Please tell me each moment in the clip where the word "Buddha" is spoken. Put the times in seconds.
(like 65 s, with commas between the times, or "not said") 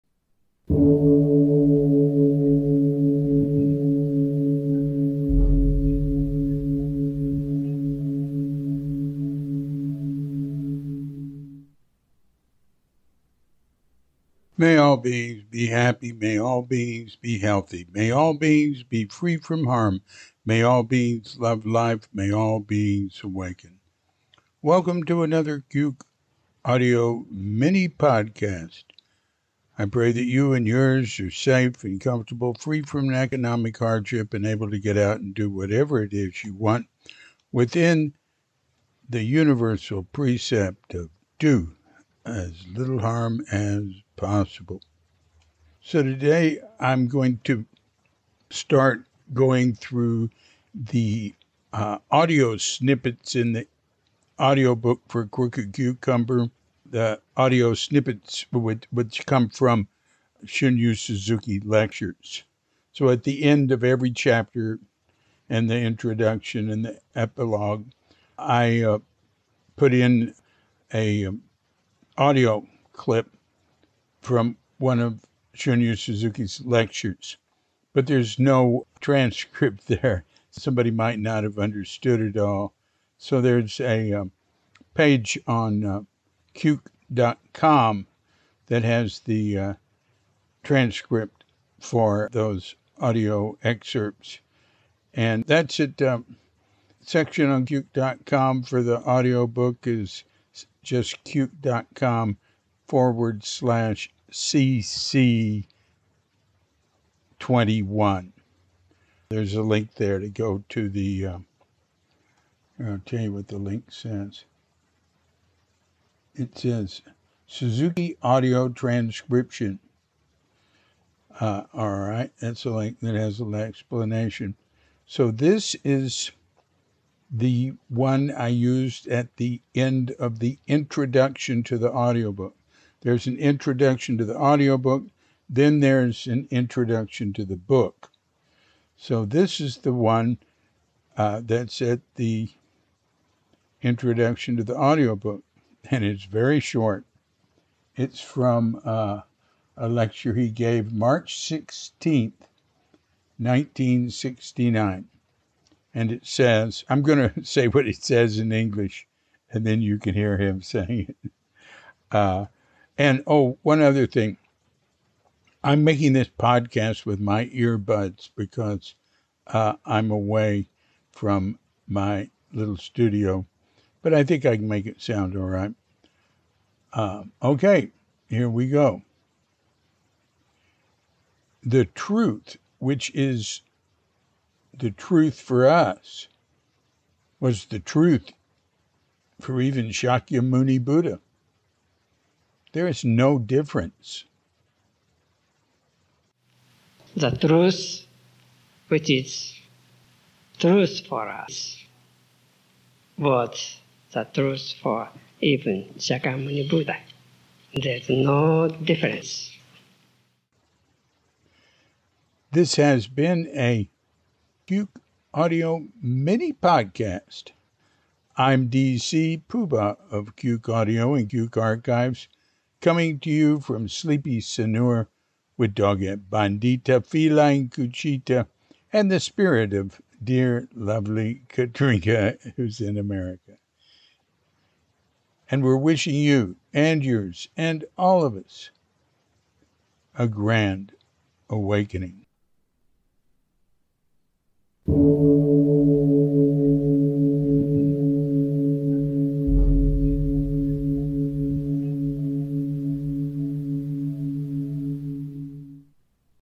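190 s, 206 s.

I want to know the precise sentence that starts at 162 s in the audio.
Uh, and oh, one other thing.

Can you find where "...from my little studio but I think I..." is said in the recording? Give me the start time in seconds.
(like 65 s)
171 s.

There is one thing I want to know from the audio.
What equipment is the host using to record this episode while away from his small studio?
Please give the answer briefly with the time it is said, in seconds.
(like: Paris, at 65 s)
earbuds, at 167 s.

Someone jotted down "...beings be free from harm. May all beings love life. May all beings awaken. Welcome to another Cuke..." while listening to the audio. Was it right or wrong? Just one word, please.
right.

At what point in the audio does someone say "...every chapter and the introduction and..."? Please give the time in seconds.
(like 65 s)
63 s.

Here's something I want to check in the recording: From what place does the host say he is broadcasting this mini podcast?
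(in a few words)
Sanur.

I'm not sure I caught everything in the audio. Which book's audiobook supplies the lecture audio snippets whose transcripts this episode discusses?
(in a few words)
Crooked Cucumber.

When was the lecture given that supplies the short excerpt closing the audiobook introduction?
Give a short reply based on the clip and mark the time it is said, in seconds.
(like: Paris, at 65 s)
March 16, 1969, at 150 s.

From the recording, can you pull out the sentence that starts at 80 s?
Somebody might not have understood it all.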